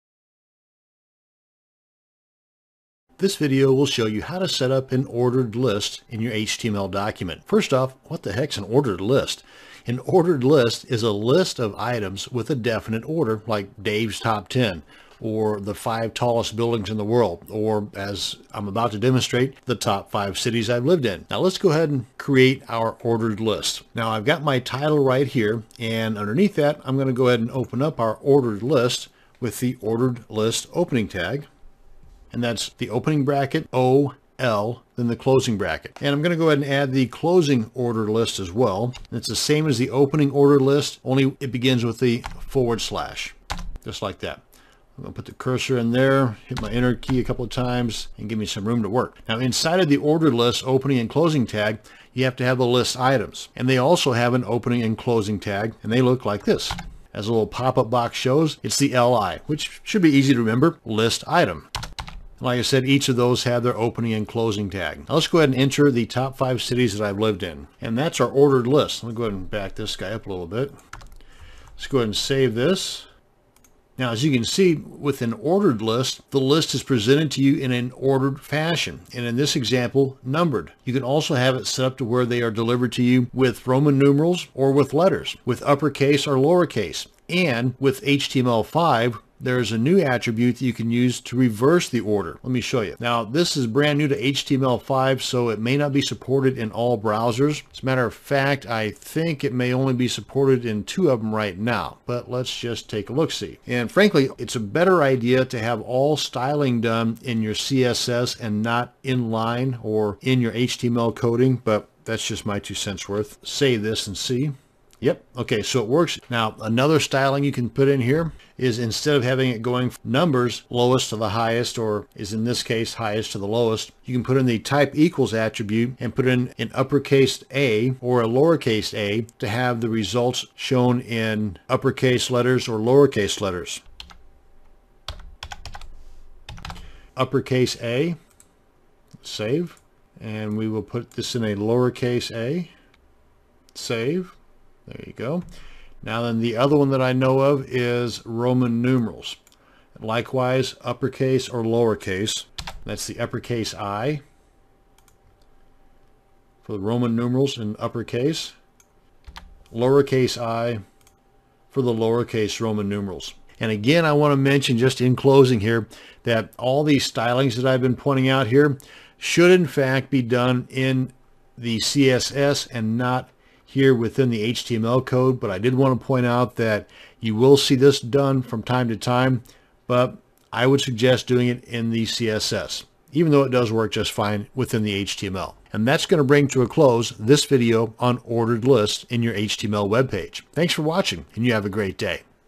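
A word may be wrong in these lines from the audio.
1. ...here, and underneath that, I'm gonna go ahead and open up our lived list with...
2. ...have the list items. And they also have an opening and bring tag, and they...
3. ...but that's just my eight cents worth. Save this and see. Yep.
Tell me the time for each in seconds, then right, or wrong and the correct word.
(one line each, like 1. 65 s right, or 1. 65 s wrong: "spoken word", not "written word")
1. 25 s wrong: "ordered", not "lived"
2. 52 s wrong: "closing", not "bring"
3. 111 s wrong: "two", not "eight".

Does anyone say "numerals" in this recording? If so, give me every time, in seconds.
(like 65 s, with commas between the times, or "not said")
83 s, 148 s, 157 s, 162 s.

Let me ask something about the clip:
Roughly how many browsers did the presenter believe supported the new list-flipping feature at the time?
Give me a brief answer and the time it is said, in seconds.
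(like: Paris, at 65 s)
2, at 100 s.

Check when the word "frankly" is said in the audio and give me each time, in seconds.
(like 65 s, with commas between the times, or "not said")
103 s.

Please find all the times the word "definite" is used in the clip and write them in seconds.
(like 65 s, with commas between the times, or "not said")
12 s.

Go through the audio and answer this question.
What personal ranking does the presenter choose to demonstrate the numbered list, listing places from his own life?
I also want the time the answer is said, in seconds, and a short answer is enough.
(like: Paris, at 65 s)
top 5 cities I've lived in, at 19 s.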